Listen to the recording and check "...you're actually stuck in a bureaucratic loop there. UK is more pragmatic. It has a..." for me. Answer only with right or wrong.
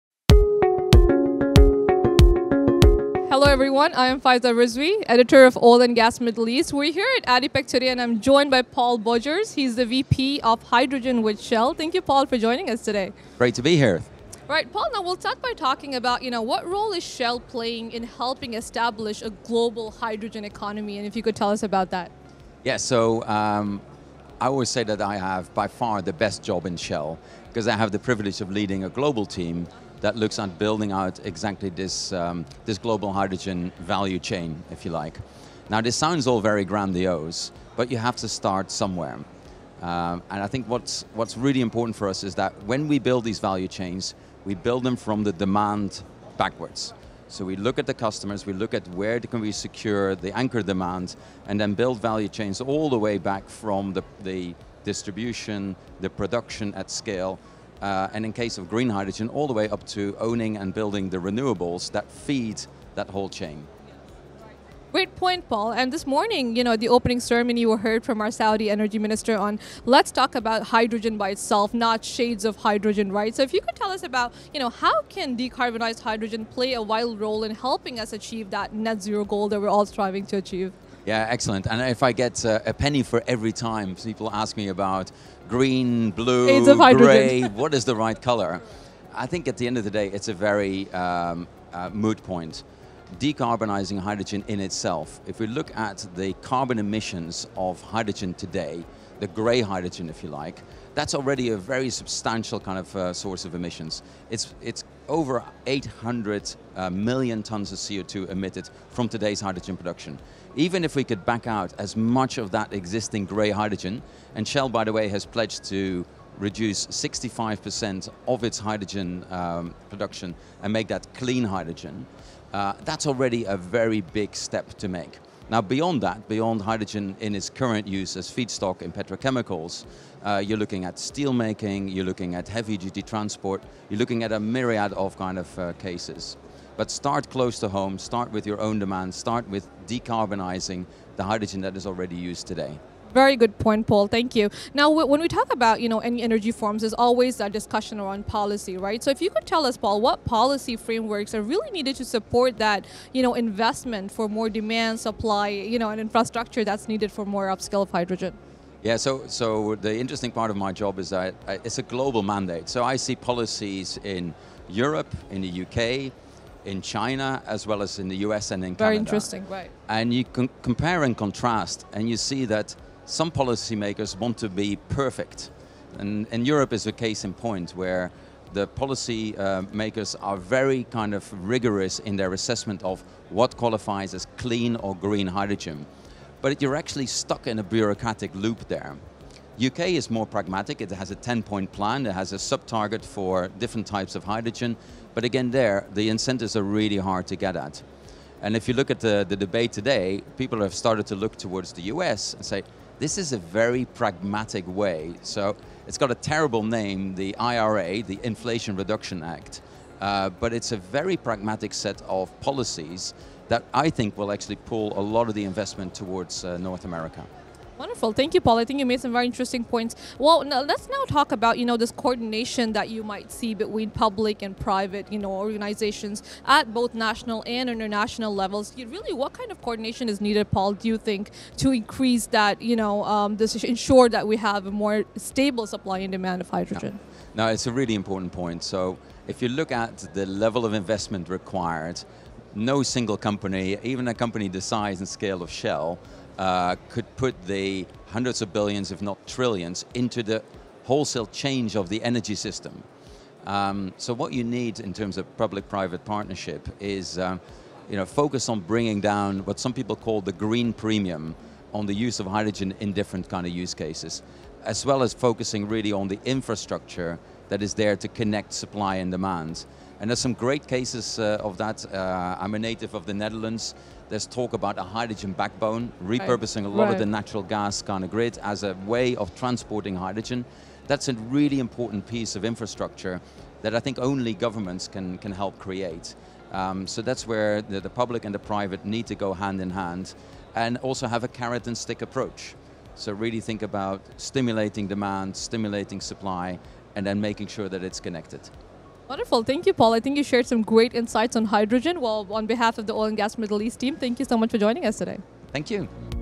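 right.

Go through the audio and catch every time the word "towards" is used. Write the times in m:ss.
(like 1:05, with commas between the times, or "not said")
3:21, 3:35.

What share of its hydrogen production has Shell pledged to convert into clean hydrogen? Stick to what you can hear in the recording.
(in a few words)
65%.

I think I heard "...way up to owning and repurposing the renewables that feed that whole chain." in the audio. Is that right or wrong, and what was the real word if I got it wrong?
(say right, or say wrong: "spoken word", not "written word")
wrong: "building", not "repurposing".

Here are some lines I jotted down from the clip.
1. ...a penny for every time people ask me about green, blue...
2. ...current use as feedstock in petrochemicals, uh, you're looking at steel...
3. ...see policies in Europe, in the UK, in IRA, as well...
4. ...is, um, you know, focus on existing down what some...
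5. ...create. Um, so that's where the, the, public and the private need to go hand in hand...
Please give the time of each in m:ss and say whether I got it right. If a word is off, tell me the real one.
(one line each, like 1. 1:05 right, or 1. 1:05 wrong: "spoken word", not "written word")
1. 1:22 right
2. 2:07 right
3. 2:42 wrong: "China", not "IRA"
4. 4:16 wrong: "bringing", not "existing"
5. 4:45 right.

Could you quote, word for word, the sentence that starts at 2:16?
But start close to home, start with your own demand, start with decarbonizing the hydrogen that is already used today.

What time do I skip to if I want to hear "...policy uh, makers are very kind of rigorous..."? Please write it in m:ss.
2:58.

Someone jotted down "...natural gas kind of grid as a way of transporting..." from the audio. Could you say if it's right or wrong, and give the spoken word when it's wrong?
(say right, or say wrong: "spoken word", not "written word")
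right.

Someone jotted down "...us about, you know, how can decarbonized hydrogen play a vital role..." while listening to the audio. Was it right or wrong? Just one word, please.
right.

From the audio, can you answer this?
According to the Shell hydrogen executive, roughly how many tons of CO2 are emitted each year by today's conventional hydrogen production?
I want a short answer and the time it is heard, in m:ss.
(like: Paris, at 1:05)
800 million, at 1:45.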